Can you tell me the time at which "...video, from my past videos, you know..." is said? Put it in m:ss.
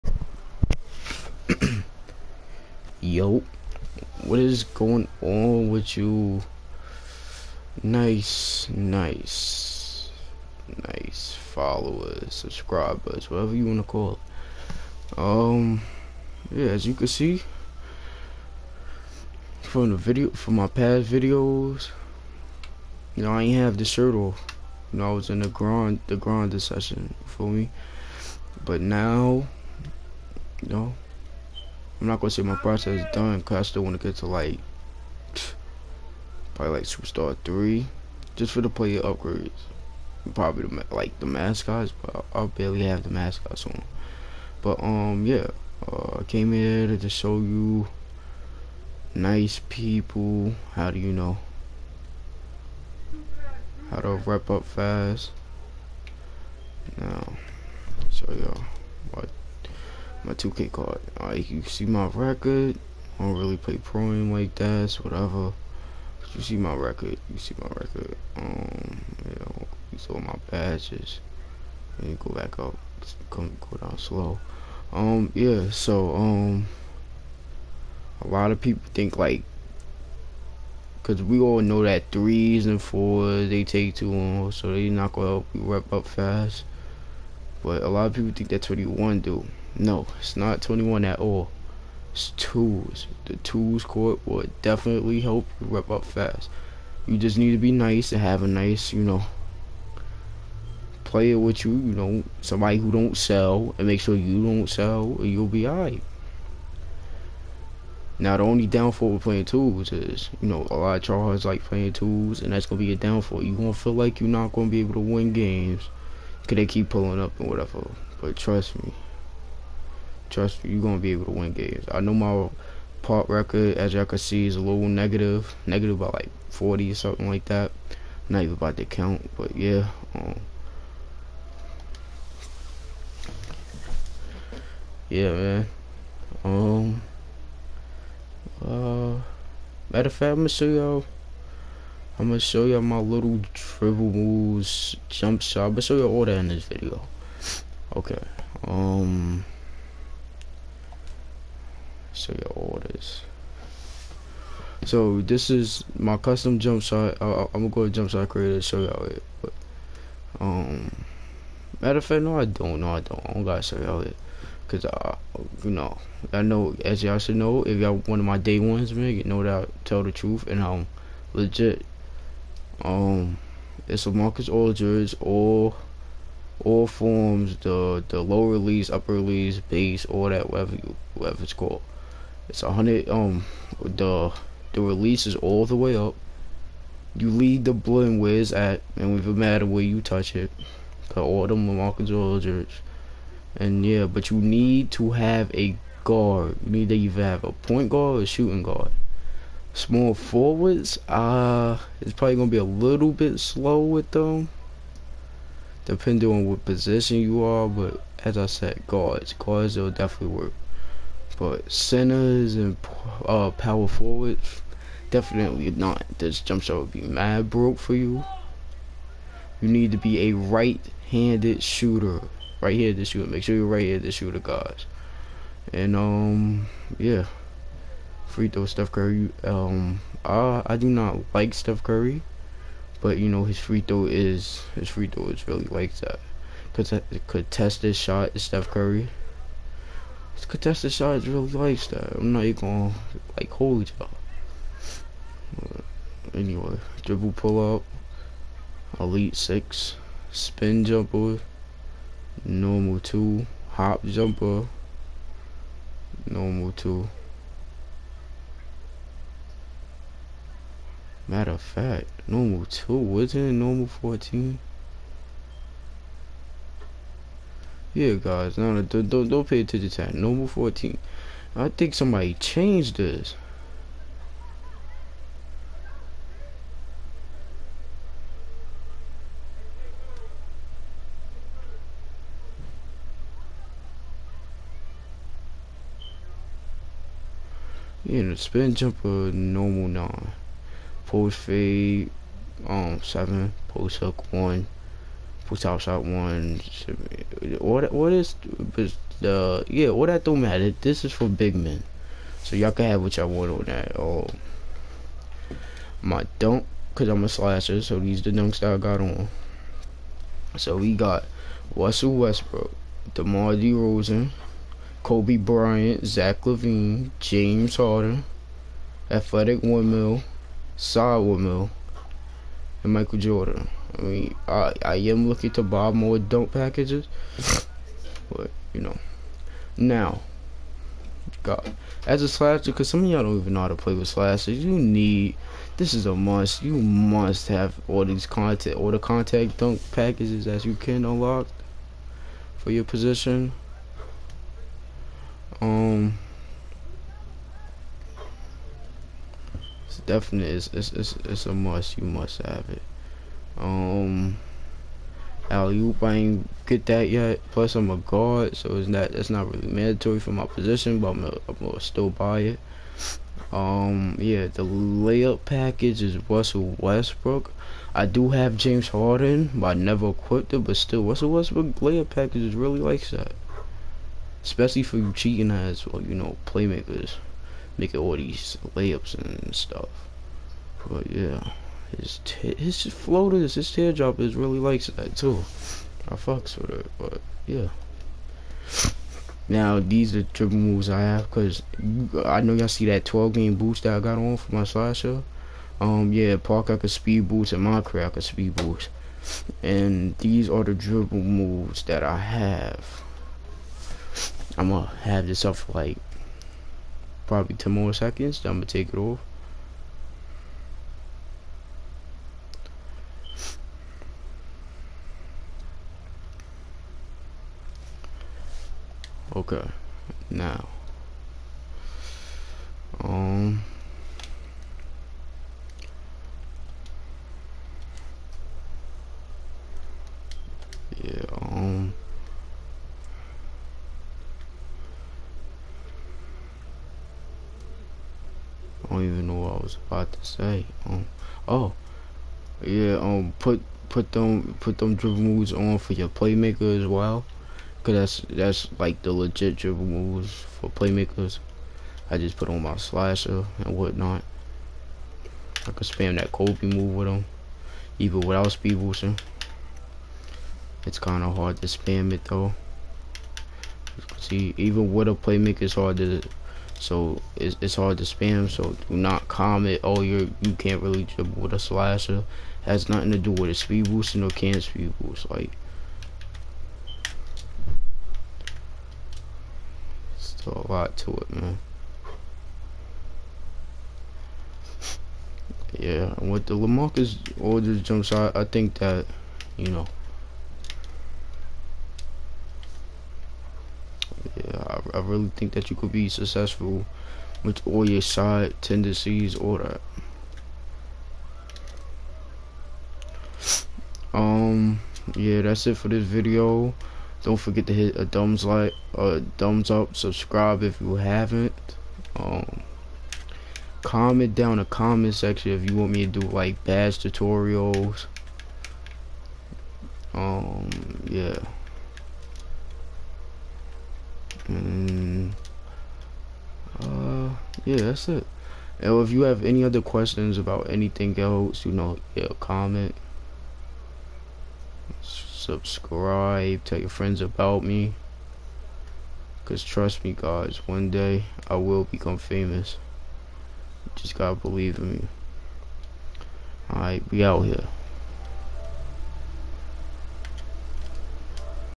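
0:19.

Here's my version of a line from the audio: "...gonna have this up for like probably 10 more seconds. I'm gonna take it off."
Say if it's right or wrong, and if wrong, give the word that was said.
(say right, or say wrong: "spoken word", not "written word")
right.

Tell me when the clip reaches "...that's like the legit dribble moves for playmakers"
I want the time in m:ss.
7:28.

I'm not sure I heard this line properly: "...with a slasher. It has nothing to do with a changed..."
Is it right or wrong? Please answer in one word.
wrong.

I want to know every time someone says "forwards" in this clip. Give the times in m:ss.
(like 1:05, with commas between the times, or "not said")
3:20, 3:33.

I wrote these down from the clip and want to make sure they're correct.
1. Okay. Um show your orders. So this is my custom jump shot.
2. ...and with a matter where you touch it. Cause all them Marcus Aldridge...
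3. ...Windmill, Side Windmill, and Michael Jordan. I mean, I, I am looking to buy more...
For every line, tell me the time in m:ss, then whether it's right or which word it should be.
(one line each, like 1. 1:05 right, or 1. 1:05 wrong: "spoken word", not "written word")
1. 2:27 right
2. 3:08 right
3. 5:19 right.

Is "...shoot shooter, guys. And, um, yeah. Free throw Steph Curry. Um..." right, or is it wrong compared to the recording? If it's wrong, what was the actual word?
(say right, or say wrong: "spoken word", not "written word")
right.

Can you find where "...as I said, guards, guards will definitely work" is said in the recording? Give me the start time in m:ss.
3:28.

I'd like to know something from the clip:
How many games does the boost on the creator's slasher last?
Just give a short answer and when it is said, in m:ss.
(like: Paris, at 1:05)
12, at 6:33.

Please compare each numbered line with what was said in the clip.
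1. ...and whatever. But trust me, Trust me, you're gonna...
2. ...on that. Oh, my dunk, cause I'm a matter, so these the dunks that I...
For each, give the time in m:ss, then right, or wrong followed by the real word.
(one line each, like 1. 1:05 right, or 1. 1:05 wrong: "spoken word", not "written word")
1. 1:57 right
2. 5:03 wrong: "slasher", not "matter".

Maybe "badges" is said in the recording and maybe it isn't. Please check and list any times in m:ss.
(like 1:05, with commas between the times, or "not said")
1:10, 8:36.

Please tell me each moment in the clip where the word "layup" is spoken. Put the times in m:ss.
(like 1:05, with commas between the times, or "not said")
6:04, 6:11, 6:18.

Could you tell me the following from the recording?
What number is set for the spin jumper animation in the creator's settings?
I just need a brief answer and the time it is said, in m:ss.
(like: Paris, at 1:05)
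9, at 4:49.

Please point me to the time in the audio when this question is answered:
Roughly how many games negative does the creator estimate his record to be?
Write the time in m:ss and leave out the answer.
2:06.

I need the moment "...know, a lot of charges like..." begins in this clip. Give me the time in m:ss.
1:50.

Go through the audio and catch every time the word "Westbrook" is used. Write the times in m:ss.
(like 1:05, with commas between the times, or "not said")
5:12, 6:06, 6:11.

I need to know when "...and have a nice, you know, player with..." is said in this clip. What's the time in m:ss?
1:38.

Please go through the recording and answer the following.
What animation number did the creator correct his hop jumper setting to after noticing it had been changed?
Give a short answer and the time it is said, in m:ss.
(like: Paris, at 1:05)
14, at 4:30.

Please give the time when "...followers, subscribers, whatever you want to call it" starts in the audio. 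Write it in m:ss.
0:11.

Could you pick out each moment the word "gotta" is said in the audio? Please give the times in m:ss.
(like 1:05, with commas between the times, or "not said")
2:43, 9:04.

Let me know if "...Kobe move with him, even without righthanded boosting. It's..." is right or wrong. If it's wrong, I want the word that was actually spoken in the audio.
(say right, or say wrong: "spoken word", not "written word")
wrong: "speed", not "righthanded".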